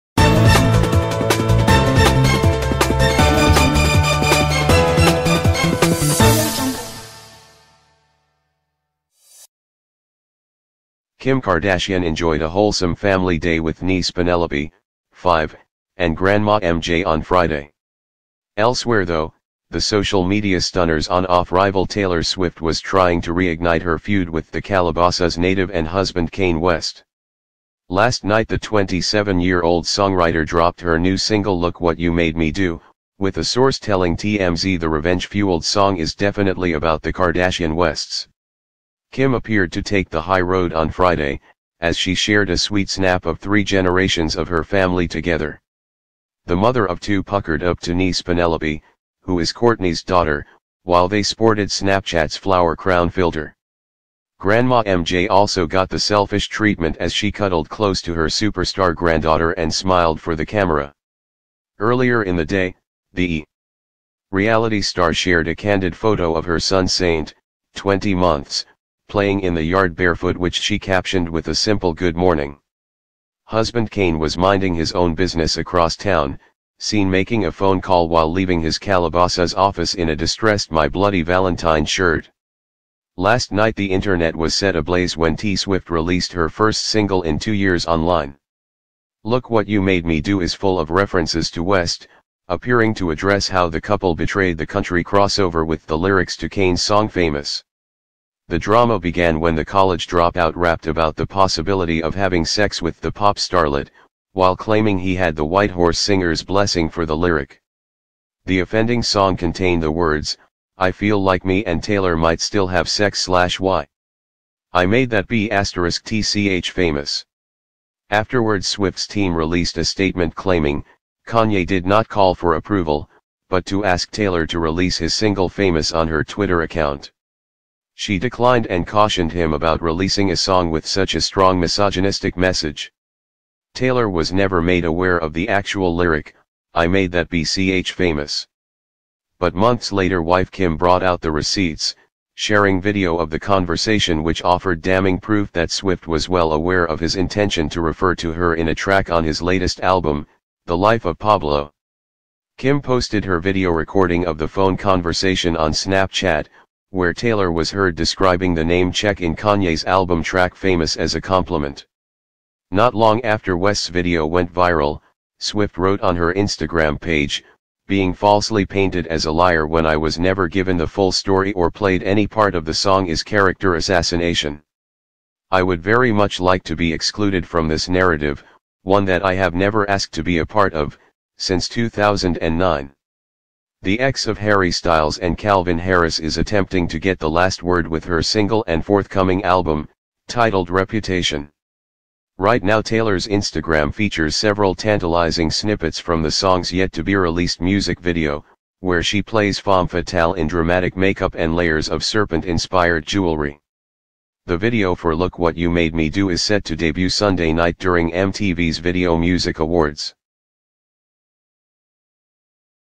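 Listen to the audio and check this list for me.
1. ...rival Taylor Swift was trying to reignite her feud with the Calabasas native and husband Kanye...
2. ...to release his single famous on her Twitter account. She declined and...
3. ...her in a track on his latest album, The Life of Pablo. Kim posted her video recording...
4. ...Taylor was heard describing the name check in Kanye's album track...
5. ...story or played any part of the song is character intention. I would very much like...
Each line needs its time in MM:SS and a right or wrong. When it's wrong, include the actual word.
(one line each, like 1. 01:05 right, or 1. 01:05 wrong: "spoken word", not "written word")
1. 00:21 right
2. 02:04 right
3. 02:28 right
4. 02:37 right
5. 02:51 wrong: "assassination", not "intention".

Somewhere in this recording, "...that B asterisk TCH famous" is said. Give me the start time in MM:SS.
01:55.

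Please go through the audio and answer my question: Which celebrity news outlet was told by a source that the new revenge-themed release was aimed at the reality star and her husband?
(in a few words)
TMZ.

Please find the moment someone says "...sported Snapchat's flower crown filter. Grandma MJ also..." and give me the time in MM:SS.
00:51.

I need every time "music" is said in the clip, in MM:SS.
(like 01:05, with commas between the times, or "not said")
03:17, 03:29.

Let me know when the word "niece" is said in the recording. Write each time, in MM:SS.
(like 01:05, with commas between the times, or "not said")
00:13, 00:47.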